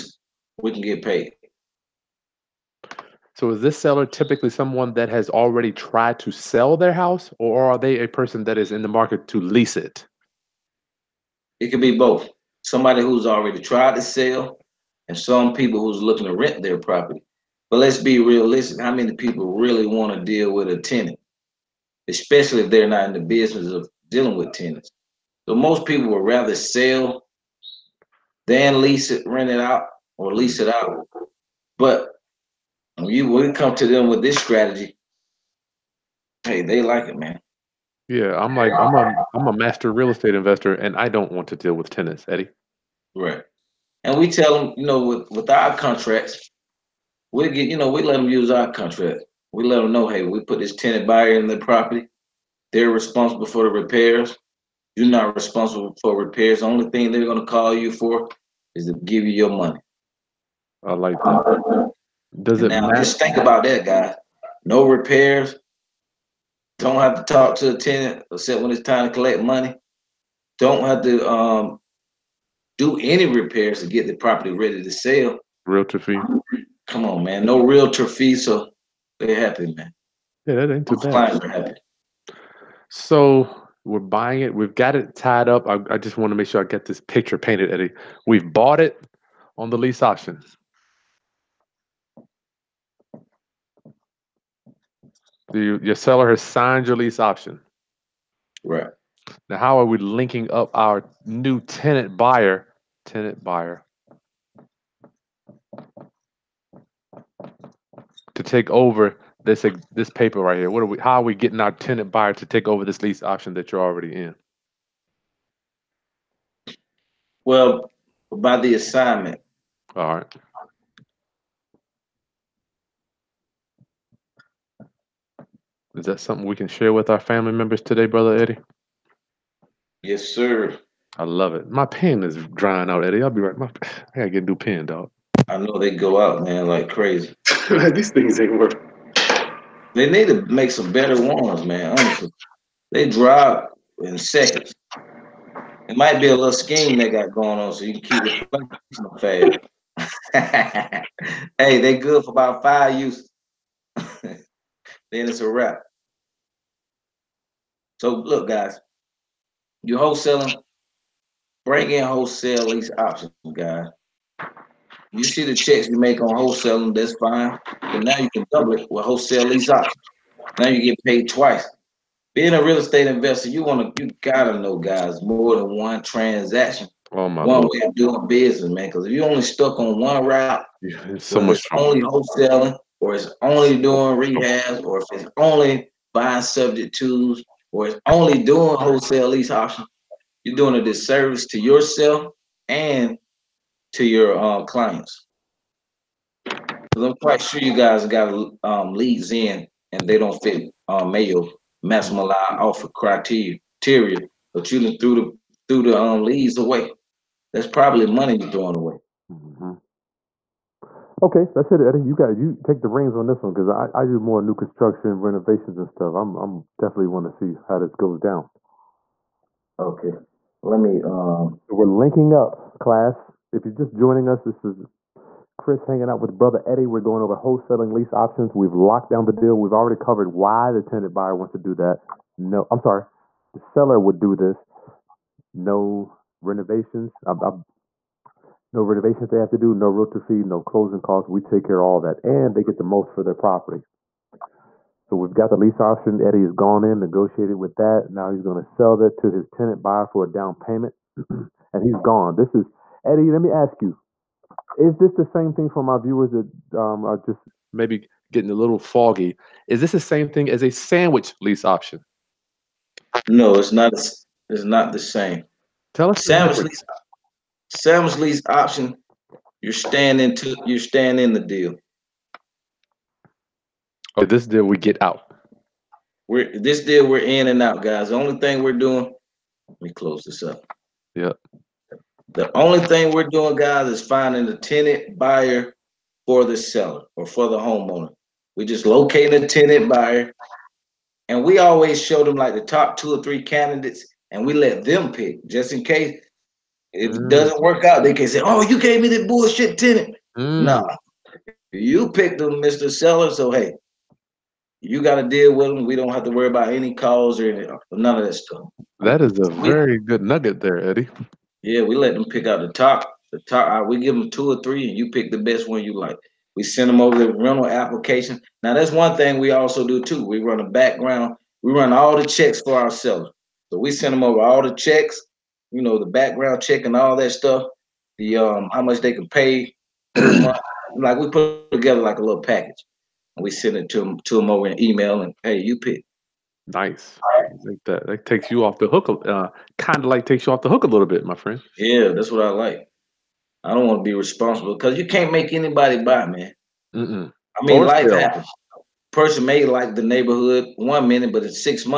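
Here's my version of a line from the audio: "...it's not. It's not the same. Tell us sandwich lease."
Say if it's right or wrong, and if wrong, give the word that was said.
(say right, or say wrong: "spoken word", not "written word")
right.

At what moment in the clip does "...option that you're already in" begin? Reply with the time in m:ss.
1:53.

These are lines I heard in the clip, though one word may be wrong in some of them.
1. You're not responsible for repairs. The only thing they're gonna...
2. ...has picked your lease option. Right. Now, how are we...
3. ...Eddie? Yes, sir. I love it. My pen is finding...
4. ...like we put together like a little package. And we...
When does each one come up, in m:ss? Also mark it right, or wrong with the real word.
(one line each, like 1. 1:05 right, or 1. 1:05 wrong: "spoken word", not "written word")
1. 0:54 right
2. 1:36 wrong: "signed", not "picked"
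3. 2:08 wrong: "drying", not "finding"
4. 5:30 right.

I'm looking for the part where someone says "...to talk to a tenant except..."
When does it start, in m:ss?
1:07.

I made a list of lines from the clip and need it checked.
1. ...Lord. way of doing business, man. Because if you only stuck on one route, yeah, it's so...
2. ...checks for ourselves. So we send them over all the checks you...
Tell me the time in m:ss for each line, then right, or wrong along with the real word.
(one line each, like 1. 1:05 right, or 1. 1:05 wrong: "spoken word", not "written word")
1. 2:57 right
2. 5:22 right.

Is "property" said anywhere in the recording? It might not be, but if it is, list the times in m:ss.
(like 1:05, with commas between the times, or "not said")
0:16, 0:51, 1:14, 4:03.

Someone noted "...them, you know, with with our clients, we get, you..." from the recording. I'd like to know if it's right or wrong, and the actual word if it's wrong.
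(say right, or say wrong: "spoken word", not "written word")
wrong: "contracts", not "clients".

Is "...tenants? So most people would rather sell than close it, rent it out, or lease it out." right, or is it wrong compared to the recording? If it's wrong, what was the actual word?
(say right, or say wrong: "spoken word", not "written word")
wrong: "lease", not "close".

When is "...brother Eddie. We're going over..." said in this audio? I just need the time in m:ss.
3:46.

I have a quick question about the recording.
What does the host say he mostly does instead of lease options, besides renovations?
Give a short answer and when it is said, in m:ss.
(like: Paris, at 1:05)
New construction, at 3:34.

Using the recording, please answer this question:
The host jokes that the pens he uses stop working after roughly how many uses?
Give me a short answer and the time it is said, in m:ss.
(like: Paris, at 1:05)
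5, at 2:32.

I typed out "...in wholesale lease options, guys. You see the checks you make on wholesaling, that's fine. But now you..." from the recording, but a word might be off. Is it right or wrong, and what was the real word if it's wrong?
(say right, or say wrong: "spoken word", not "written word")
right.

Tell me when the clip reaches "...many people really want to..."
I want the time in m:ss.
0:18.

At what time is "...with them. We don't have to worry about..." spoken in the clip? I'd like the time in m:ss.
5:05.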